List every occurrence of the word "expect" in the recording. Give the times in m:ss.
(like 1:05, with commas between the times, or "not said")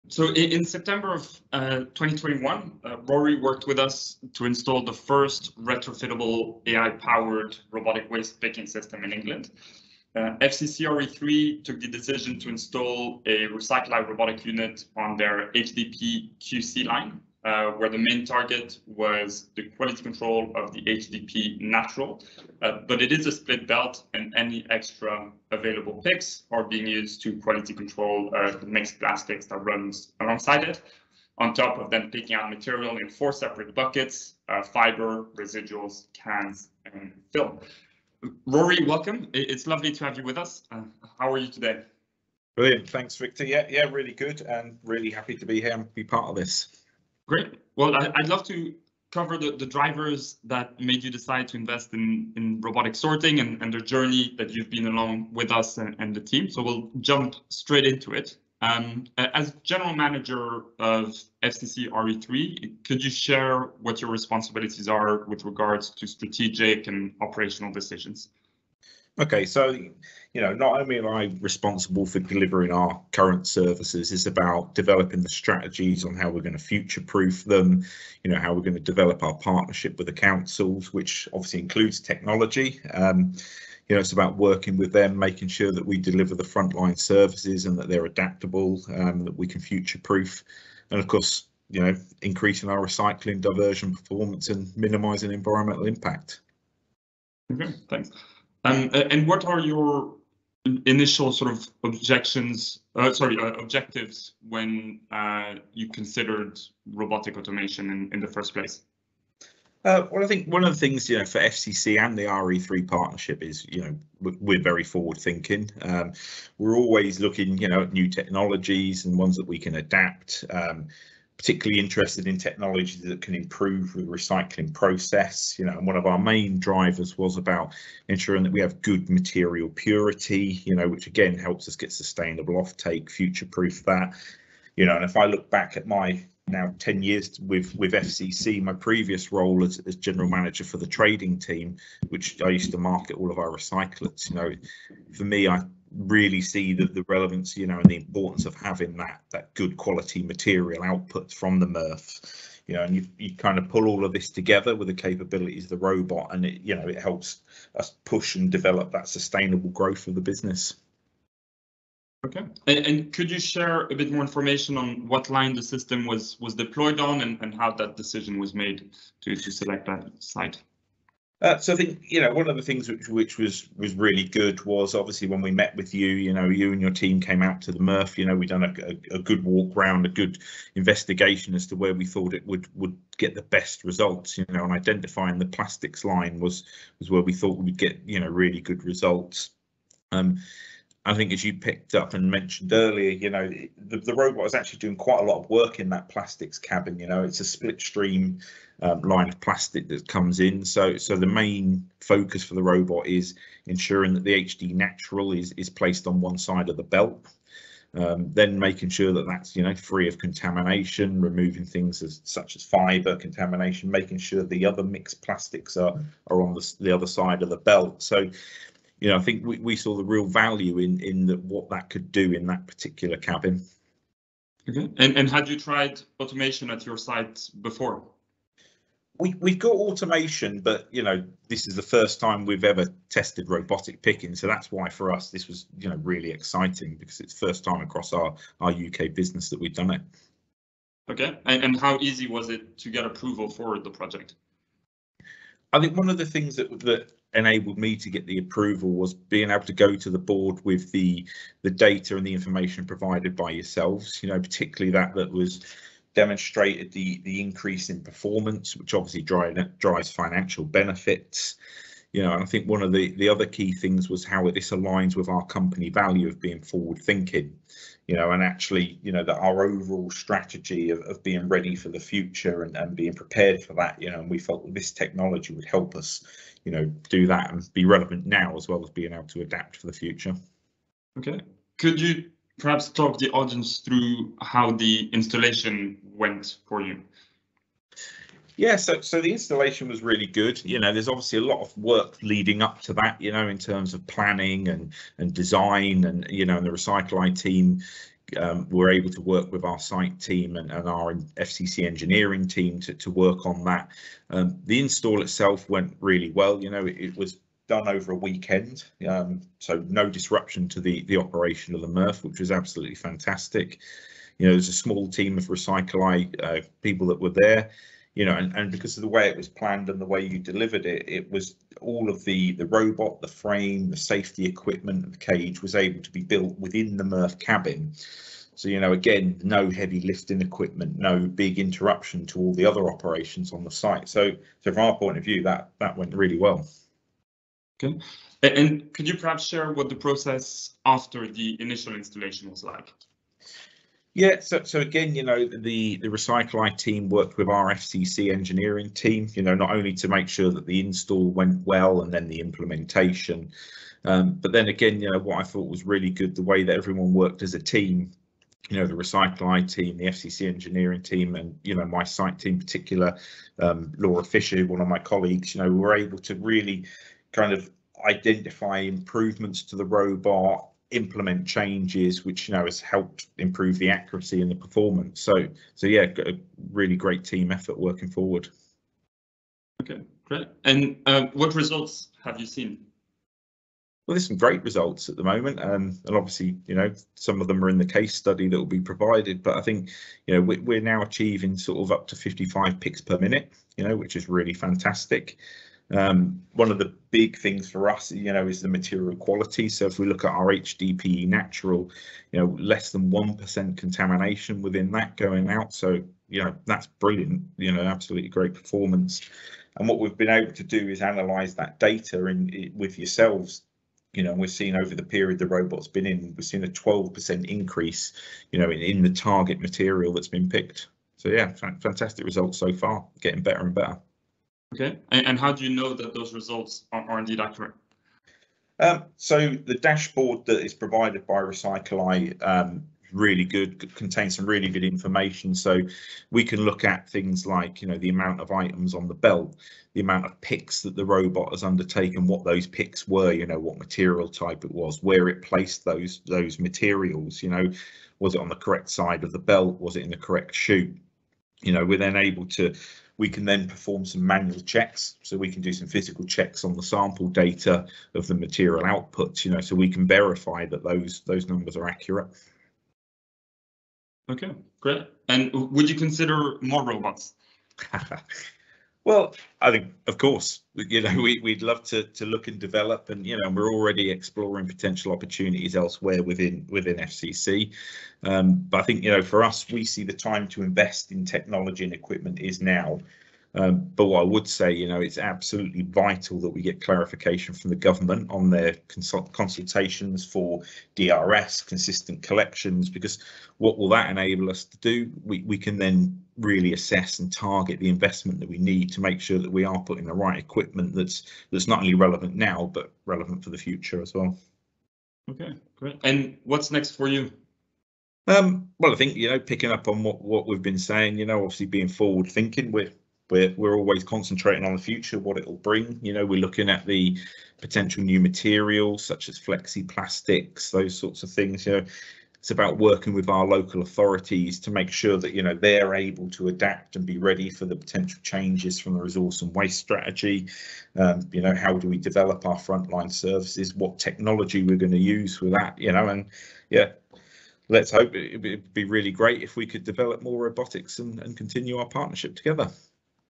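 not said.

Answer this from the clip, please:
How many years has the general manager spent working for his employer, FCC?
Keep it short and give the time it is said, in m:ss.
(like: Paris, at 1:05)
10 years, at 2:16.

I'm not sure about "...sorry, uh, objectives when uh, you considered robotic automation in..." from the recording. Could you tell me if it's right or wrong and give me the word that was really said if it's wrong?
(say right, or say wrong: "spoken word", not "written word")
right.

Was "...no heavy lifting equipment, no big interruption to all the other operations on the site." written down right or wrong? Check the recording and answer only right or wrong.
right.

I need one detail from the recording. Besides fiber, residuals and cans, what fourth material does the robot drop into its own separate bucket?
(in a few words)
Film.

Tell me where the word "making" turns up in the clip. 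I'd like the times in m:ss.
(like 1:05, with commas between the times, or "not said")
1:25, 3:28, 3:33.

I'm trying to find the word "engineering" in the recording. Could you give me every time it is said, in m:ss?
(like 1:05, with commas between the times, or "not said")
5:01, 5:48, 6:00.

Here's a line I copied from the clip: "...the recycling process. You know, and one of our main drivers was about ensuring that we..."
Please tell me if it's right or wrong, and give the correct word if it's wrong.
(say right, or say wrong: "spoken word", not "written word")
right.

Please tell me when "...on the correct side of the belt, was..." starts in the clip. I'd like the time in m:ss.
7:28.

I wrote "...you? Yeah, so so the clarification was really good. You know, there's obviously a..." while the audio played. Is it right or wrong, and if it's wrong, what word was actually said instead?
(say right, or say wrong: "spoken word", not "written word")
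wrong: "installation", not "clarification".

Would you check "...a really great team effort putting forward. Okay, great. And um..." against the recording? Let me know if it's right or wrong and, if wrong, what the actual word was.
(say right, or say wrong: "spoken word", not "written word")
wrong: "working", not "putting".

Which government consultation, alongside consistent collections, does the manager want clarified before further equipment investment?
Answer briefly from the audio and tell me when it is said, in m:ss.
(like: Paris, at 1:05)
DRS, at 8:10.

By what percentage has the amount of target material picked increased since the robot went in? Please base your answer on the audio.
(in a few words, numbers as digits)
12%.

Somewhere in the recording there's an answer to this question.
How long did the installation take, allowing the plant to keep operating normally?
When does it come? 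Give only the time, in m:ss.
5:07.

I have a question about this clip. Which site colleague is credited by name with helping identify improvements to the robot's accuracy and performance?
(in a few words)
Laura Fisher.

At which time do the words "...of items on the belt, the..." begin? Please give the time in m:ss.
7:18.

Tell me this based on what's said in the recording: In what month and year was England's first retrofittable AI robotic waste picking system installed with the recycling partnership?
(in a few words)
September 2021.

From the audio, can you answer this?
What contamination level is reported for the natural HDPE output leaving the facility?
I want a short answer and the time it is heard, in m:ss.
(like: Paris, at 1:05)
Less than 1%, at 6:42.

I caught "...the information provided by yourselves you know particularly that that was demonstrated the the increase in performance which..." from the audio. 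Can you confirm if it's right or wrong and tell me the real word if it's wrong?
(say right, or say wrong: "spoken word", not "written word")
right.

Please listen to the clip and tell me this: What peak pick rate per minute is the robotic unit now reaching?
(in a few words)
55.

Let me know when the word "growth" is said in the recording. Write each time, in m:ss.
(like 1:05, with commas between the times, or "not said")
2:39.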